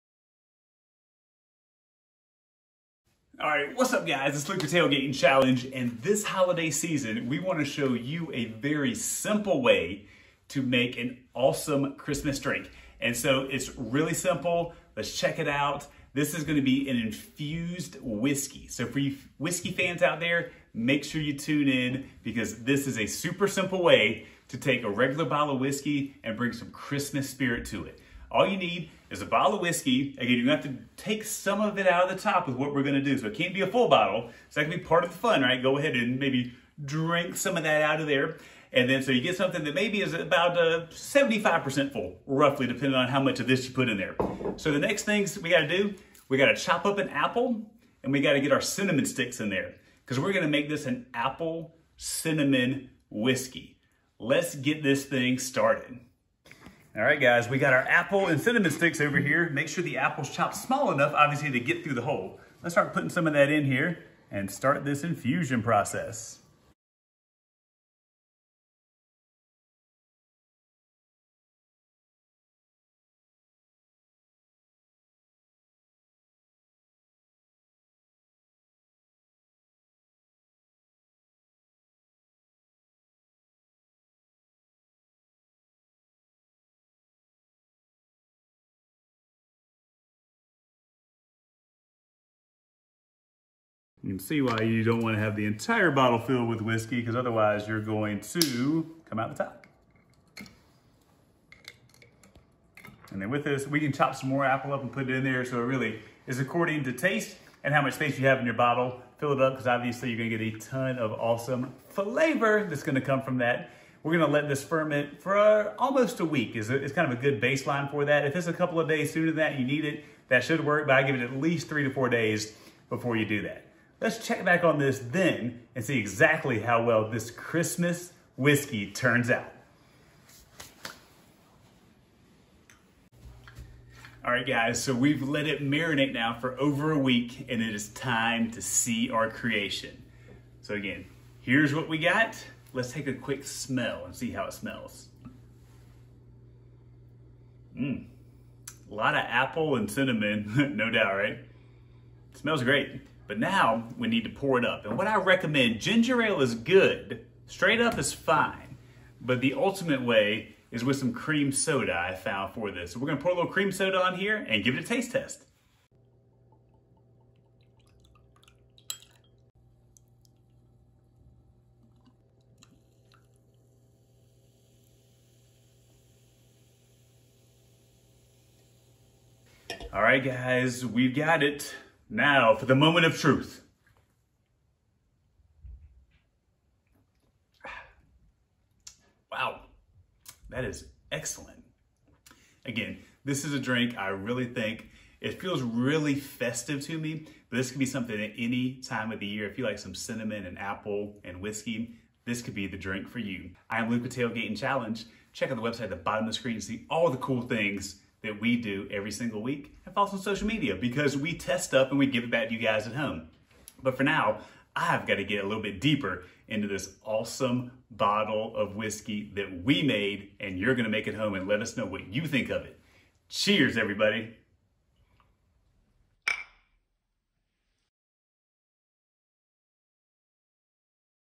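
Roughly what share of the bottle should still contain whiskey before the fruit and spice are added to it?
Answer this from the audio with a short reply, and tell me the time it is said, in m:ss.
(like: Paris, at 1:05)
75%, at 0:40.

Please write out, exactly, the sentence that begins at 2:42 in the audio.
So we're gonna pour a little cream soda on here and give it a taste test.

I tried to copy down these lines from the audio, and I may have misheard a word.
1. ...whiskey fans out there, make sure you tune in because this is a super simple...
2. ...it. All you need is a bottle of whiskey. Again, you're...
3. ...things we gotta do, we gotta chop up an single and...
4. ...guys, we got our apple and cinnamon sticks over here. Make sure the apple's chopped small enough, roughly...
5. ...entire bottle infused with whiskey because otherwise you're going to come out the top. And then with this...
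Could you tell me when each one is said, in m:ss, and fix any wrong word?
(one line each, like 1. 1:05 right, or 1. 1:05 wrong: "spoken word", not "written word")
1. 0:19 right
2. 0:27 right
3. 0:45 wrong: "apple", not "single"
4. 0:57 wrong: "obviously", not "roughly"
5. 1:35 wrong: "filled", not "infused".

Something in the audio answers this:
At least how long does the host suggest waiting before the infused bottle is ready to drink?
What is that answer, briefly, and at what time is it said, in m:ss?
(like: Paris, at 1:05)
3 to 4 days, at 2:01.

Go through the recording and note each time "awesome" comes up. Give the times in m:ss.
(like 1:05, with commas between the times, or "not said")
0:11, 1:51, 3:37.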